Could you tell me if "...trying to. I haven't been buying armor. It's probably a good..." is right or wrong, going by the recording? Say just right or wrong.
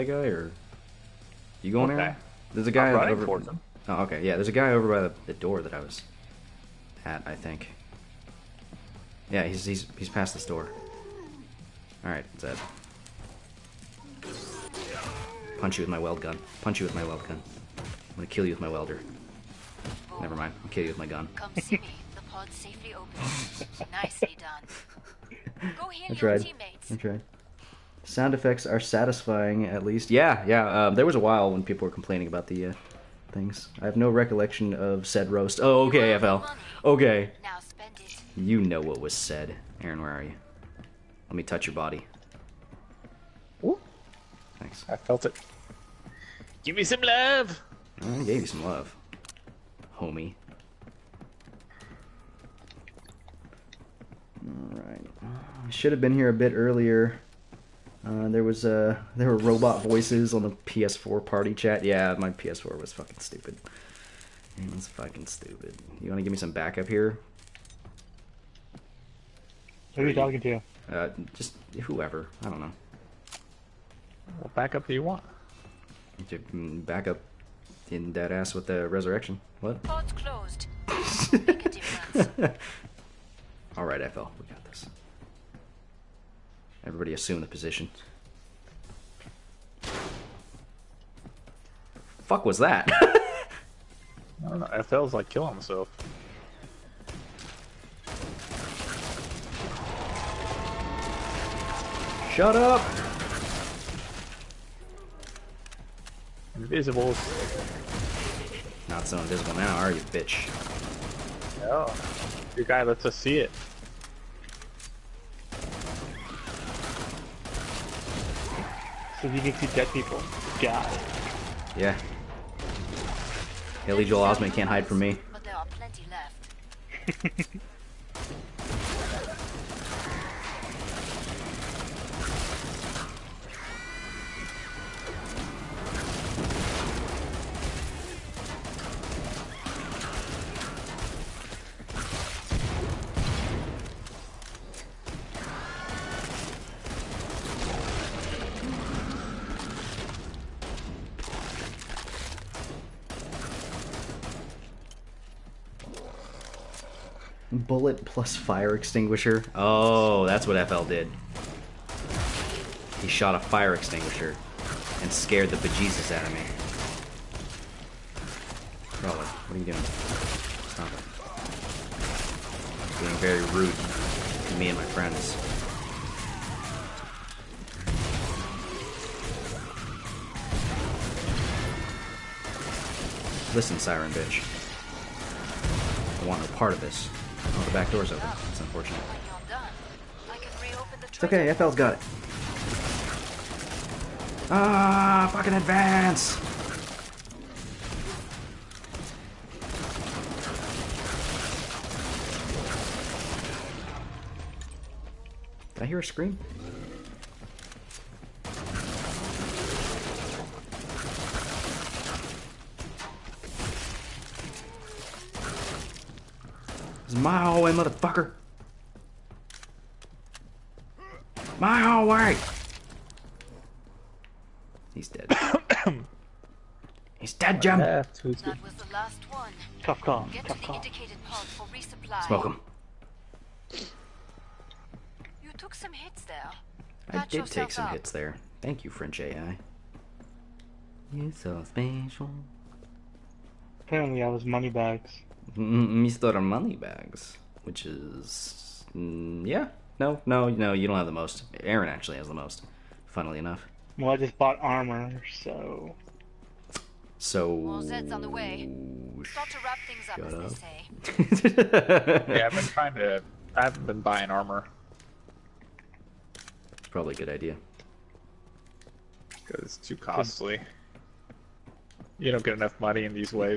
right.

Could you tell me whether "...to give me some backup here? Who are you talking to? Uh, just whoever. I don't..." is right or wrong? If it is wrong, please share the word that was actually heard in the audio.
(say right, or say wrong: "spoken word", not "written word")
right.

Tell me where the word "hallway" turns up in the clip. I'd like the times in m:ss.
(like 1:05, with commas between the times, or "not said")
3:37, 3:41.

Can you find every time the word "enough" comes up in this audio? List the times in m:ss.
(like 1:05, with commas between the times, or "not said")
4:13, 4:32.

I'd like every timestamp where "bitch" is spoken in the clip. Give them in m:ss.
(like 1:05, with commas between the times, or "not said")
1:50, 3:04.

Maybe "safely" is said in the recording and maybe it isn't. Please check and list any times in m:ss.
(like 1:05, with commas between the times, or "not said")
0:22.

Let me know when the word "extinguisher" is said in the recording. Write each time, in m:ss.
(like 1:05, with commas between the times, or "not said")
2:38, 2:43.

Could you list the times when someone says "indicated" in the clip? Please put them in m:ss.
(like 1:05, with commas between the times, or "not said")
3:50.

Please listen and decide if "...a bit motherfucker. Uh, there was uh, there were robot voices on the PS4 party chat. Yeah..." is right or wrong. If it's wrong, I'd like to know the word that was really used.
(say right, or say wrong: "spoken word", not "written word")
wrong: "earlier", not "motherfucker".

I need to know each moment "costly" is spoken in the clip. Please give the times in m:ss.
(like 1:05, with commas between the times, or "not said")
4:29.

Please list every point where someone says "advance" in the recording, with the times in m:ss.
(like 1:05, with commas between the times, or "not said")
3:15.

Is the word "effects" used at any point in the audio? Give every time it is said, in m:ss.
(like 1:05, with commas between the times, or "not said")
0:28.